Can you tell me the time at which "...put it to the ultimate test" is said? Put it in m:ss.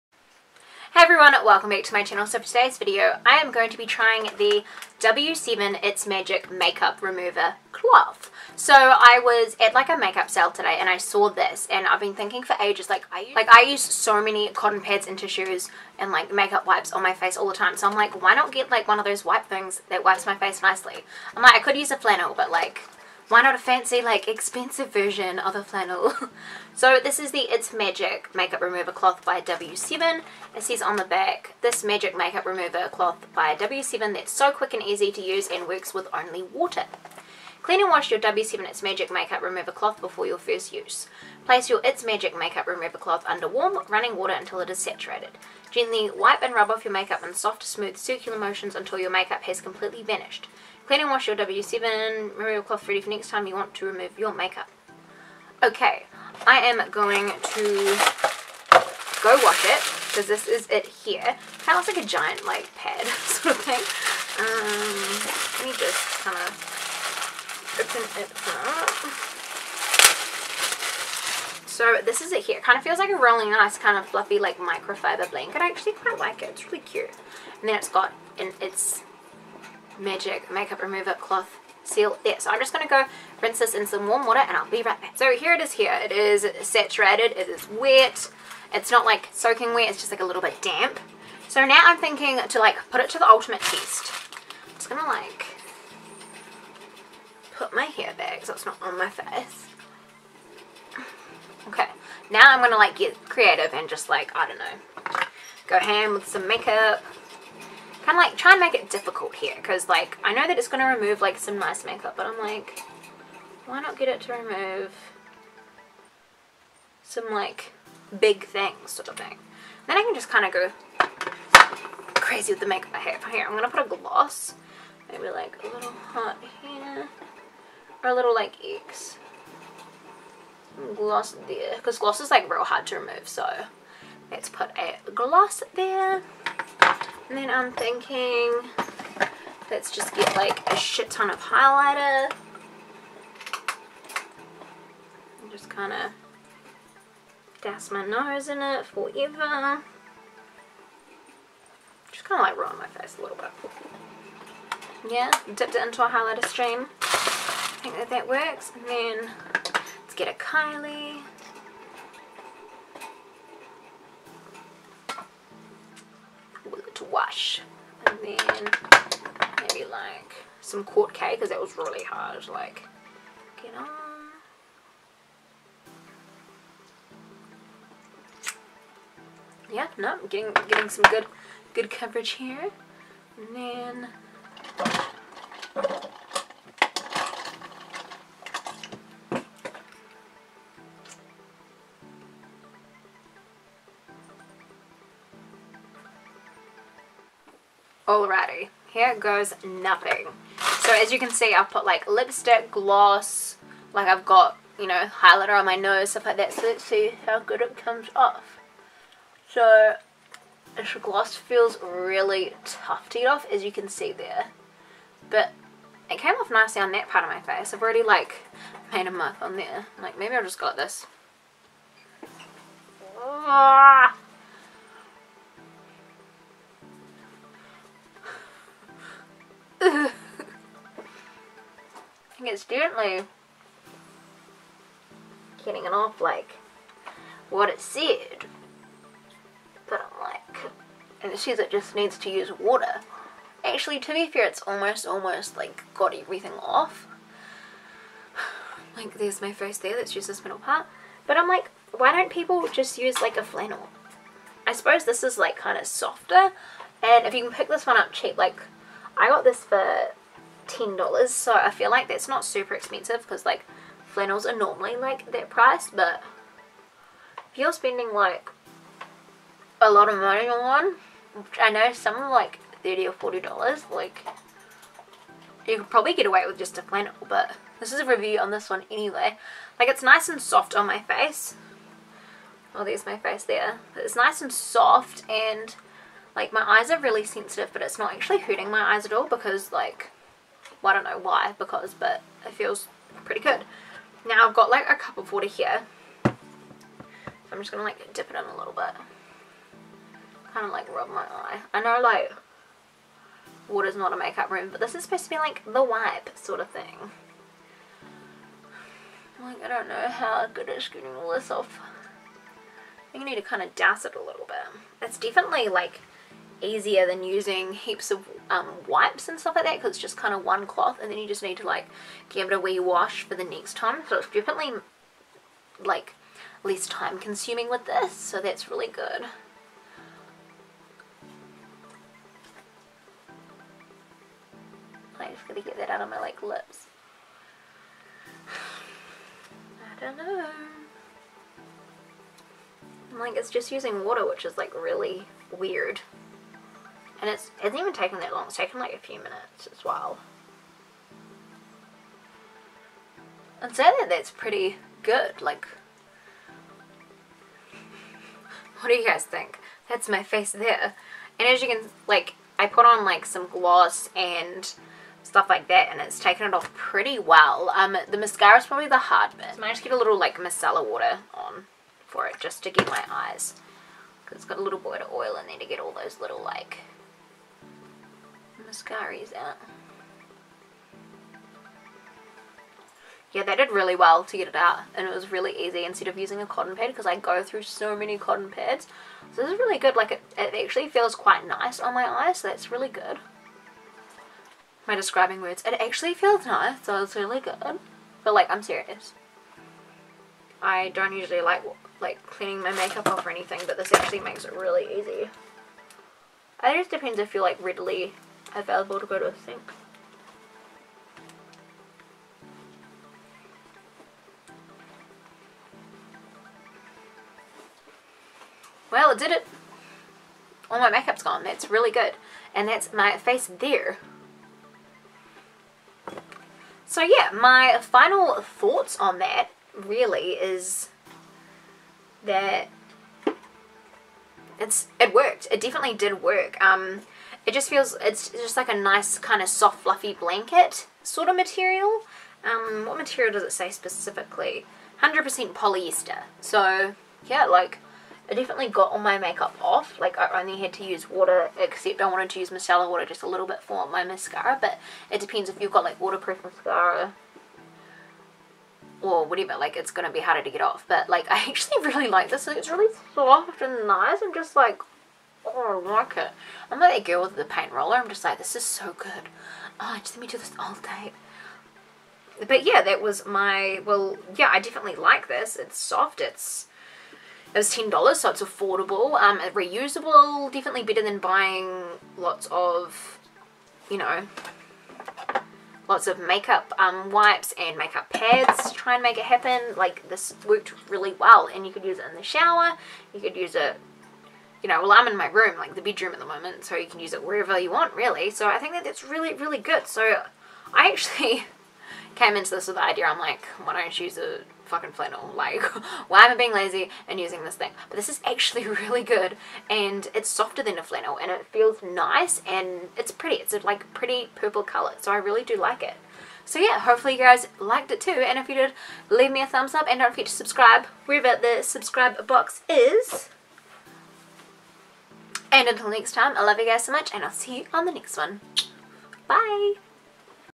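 1:32.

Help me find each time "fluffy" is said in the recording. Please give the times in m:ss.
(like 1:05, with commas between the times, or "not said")
1:14, 7:19.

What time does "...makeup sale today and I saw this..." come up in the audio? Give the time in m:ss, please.
0:09.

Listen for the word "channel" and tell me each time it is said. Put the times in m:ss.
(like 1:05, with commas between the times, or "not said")
0:02.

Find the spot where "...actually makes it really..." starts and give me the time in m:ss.
6:43.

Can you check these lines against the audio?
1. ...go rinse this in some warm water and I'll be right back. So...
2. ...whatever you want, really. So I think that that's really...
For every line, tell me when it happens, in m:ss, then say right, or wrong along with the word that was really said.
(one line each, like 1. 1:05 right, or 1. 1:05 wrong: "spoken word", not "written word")
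1. 1:22 right
2. 8:17 wrong: "wherever", not "whatever".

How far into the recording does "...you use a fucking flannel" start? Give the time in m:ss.
8:23.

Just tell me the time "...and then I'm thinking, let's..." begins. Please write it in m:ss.
2:17.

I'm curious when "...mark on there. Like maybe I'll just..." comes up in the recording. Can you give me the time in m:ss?
3:39.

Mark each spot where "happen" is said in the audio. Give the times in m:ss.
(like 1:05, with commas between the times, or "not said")
8:09.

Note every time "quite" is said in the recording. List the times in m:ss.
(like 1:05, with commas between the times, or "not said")
1:15, 6:31.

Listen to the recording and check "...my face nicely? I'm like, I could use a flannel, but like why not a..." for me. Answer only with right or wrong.
right.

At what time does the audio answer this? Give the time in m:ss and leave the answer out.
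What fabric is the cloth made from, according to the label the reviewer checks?
7:25.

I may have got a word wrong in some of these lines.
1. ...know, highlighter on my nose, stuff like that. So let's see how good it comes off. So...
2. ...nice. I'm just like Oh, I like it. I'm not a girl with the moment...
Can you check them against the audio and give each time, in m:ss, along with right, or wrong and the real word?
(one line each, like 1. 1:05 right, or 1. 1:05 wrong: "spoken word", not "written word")
1. 3:24 right
2. 7:43 wrong: "paint", not "moment".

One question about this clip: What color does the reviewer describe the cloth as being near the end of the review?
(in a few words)
Purple.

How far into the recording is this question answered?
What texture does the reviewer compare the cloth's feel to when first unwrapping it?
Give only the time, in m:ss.
1:14.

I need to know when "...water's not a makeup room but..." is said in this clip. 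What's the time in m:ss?
5:03.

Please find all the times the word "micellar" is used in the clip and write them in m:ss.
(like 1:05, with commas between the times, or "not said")
6:10, 7:32.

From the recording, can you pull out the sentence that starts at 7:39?
Like it's going to be harder to get off.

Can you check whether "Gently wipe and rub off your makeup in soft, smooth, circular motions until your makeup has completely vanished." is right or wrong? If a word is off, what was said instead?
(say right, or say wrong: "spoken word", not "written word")
right.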